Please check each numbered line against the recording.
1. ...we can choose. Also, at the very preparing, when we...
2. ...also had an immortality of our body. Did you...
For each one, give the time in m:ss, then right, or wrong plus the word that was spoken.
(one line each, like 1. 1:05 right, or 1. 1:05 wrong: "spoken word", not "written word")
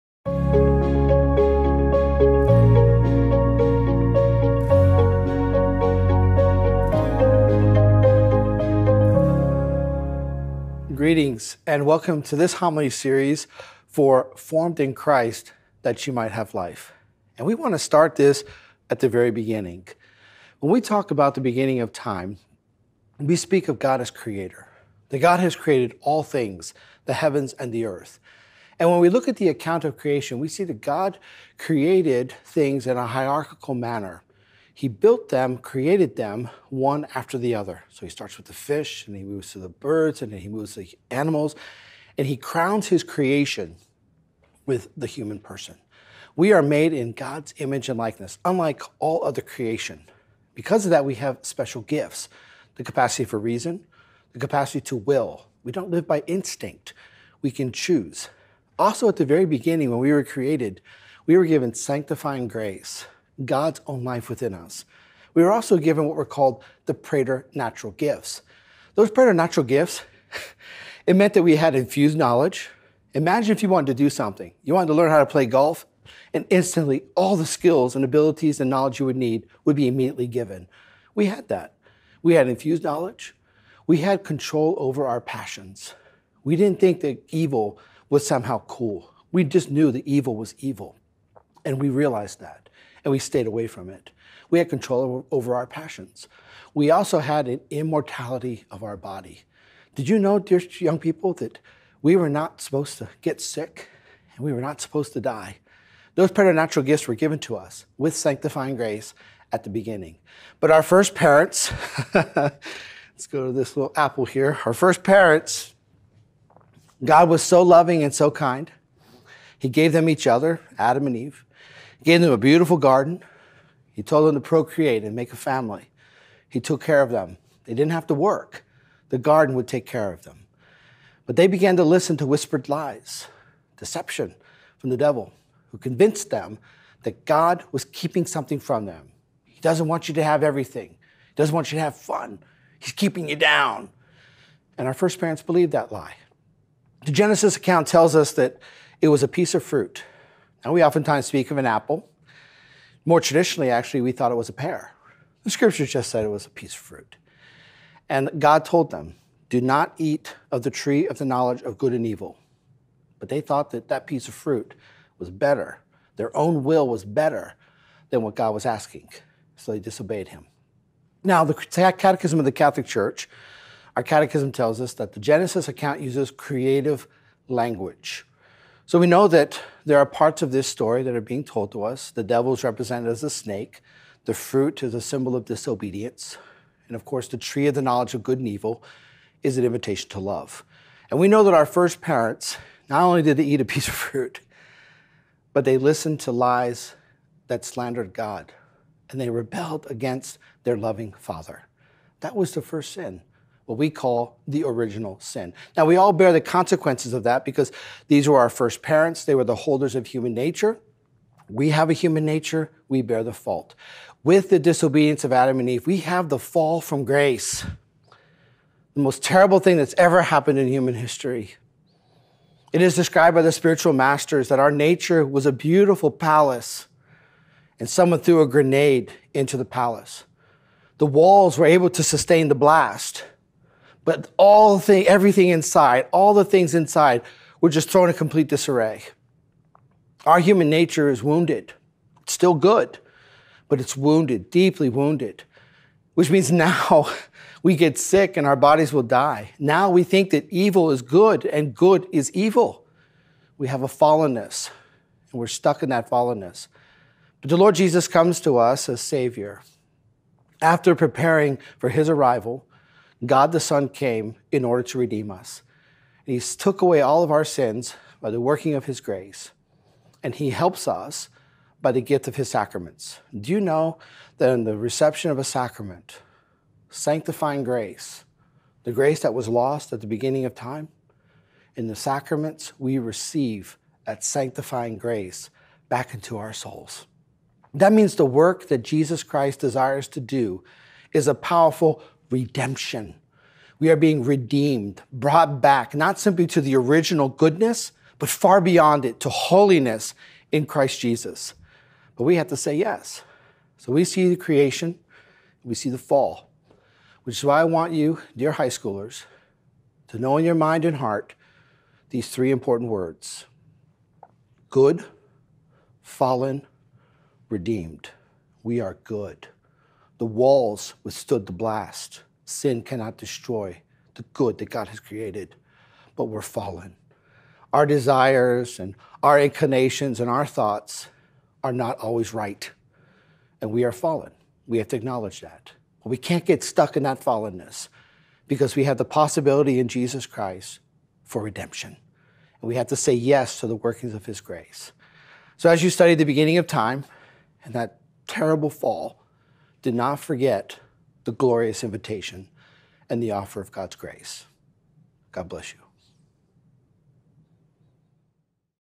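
1. 0:57 wrong: "beginning", not "preparing"
2. 1:36 right.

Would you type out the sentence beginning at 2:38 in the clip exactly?
And God told them, Do not eat of the tree of the knowledge of good and evil.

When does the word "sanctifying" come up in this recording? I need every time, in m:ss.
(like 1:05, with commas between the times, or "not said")
1:01, 1:48, 4:36, 4:44.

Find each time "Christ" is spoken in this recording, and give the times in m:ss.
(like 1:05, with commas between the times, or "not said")
0:14, 4:49, 5:00, 5:40.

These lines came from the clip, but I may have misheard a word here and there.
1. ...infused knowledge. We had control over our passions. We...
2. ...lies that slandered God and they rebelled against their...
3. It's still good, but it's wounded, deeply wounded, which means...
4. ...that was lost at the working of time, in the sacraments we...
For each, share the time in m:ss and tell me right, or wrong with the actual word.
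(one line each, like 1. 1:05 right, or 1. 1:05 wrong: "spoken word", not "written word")
1. 1:22 right
2. 3:16 right
3. 4:02 right
4. 4:39 wrong: "beginning", not "working".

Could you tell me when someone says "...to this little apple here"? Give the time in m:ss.
1:53.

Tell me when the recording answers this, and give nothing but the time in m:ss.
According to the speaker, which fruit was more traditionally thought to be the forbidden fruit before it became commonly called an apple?
2:34.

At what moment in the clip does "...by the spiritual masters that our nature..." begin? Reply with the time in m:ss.
3:43.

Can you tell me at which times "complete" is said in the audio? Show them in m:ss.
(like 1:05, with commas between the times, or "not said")
3:58.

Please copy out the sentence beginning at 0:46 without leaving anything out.
We are made in God's image and likeness, unlike all other creation.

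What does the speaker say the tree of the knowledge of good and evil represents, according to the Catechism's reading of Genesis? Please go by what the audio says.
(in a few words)
an invitation to love.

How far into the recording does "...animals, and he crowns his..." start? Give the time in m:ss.
0:41.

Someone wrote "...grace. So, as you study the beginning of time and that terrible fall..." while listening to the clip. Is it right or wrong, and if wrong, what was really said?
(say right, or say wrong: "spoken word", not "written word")
right.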